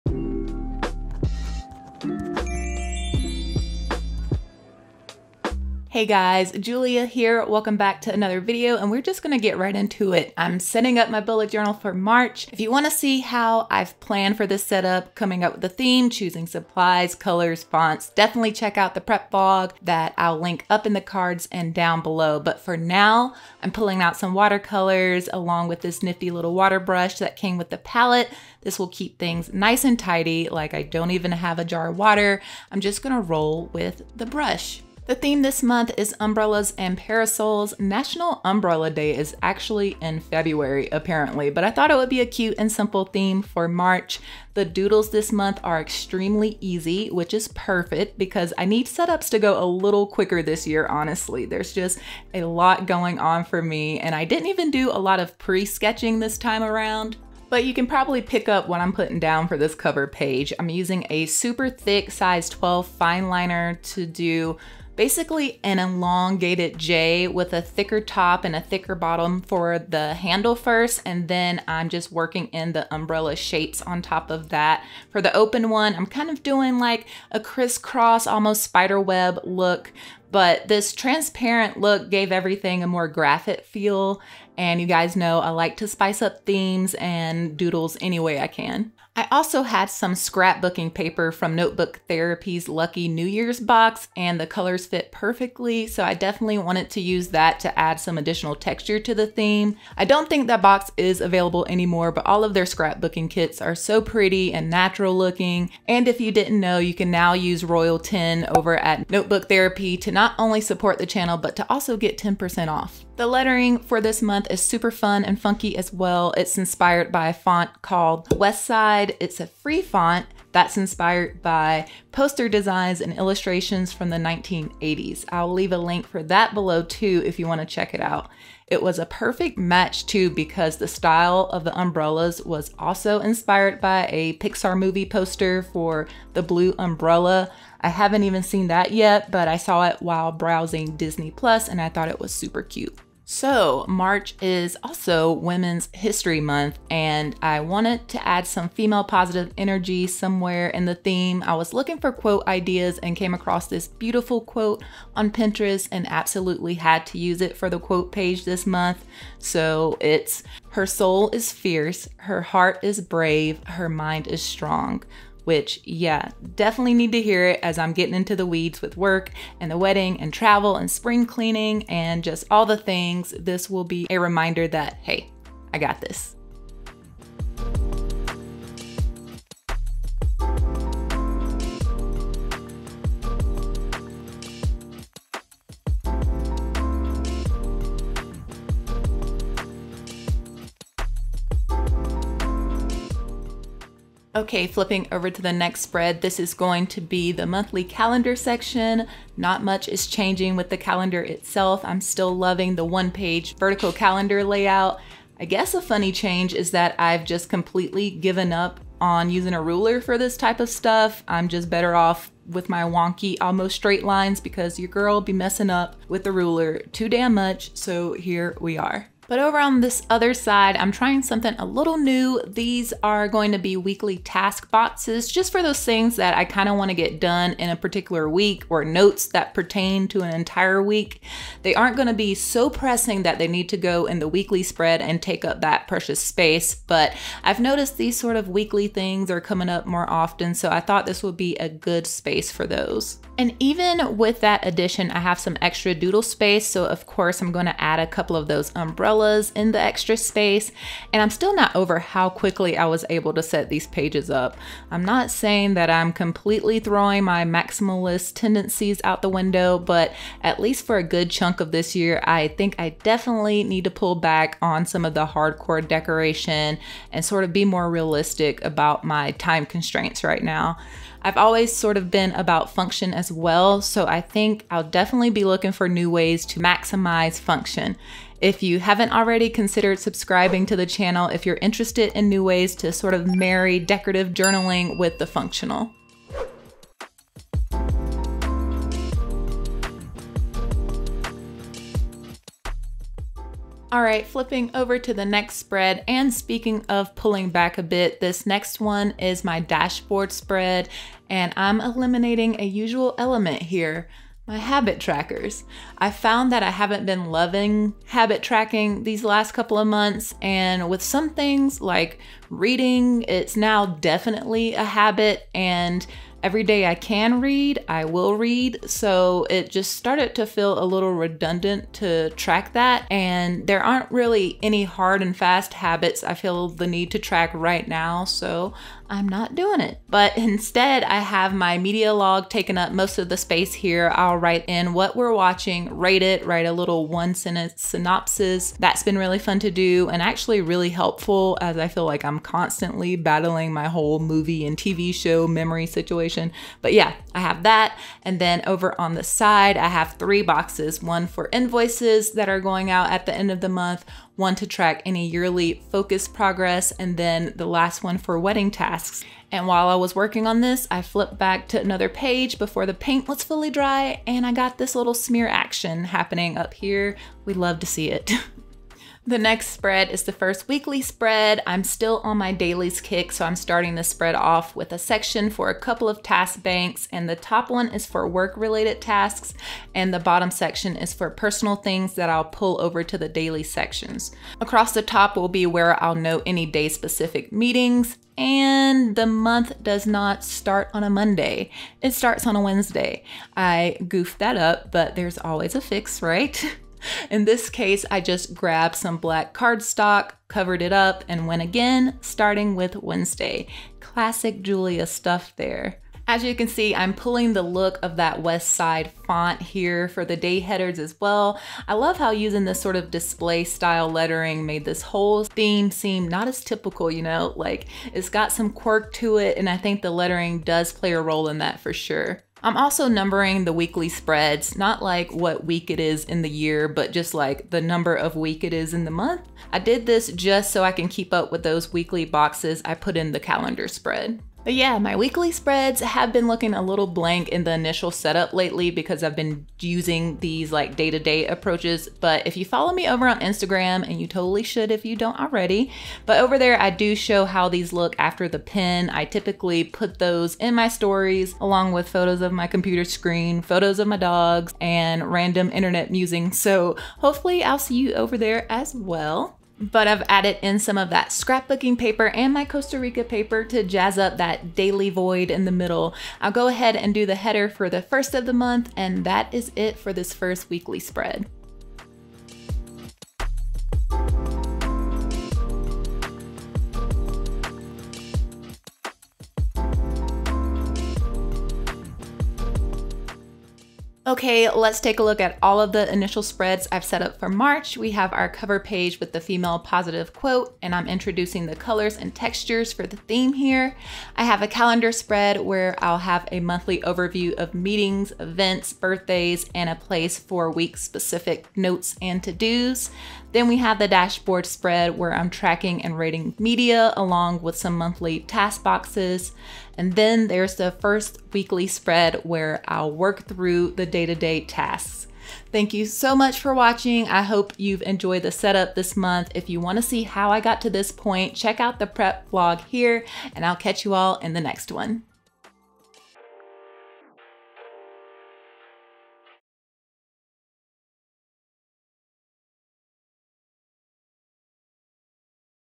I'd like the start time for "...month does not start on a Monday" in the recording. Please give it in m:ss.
6:29.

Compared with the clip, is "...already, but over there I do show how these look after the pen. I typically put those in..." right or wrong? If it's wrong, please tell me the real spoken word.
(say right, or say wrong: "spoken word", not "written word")
right.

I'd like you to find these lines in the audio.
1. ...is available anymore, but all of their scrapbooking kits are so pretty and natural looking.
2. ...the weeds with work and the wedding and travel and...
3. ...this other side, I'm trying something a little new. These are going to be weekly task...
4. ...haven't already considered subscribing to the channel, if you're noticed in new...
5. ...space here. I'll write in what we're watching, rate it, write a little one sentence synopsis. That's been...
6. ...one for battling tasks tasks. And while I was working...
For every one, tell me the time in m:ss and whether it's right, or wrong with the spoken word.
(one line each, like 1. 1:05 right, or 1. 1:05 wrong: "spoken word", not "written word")
1. 1:40 right
2. 2:48 right
3. 3:39 right
4. 4:38 wrong: "interested", not "noticed"
5. 5:33 right
6. 5:58 wrong: "wedding", not "battling".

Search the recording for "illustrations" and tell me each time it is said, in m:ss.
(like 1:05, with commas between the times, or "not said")
2:03.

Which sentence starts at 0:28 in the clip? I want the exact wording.
This will keep things nice and tidy, like I don't even have a jar of water.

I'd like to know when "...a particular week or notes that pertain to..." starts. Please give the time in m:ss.
3:47.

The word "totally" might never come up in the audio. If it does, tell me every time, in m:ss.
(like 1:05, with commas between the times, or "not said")
7:24.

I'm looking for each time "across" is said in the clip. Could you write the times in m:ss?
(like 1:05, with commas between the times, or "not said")
2:33, 6:24.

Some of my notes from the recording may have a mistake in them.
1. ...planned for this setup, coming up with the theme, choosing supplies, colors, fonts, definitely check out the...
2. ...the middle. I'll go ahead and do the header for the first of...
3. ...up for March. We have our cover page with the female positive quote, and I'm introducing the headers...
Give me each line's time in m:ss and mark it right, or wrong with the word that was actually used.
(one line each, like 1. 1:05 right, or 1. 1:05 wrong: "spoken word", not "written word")
1. 0:13 right
2. 7:45 right
3. 8:07 wrong: "colors", not "headers".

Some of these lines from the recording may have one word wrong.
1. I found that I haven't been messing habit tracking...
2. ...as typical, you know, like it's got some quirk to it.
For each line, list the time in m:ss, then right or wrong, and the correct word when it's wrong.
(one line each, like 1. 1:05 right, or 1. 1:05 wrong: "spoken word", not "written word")
1. 5:05 wrong: "loving", not "messing"
2. 6:56 right.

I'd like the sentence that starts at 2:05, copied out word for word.
I'll leave a link for that below too if you want to check it out.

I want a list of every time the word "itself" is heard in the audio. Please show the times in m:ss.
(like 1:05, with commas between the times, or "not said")
3:21.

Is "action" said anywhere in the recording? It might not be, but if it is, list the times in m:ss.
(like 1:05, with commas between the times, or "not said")
6:05.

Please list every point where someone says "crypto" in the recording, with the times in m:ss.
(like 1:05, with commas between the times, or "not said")
not said.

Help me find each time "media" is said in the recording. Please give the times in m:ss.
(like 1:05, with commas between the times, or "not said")
5:31, 8:26.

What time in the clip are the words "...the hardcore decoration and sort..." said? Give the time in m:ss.
4:25.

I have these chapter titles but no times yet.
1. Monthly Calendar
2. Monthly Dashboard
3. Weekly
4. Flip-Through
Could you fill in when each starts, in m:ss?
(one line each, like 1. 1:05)
1. 3:16
2. 4:58
3. 6:09
4. 8:08.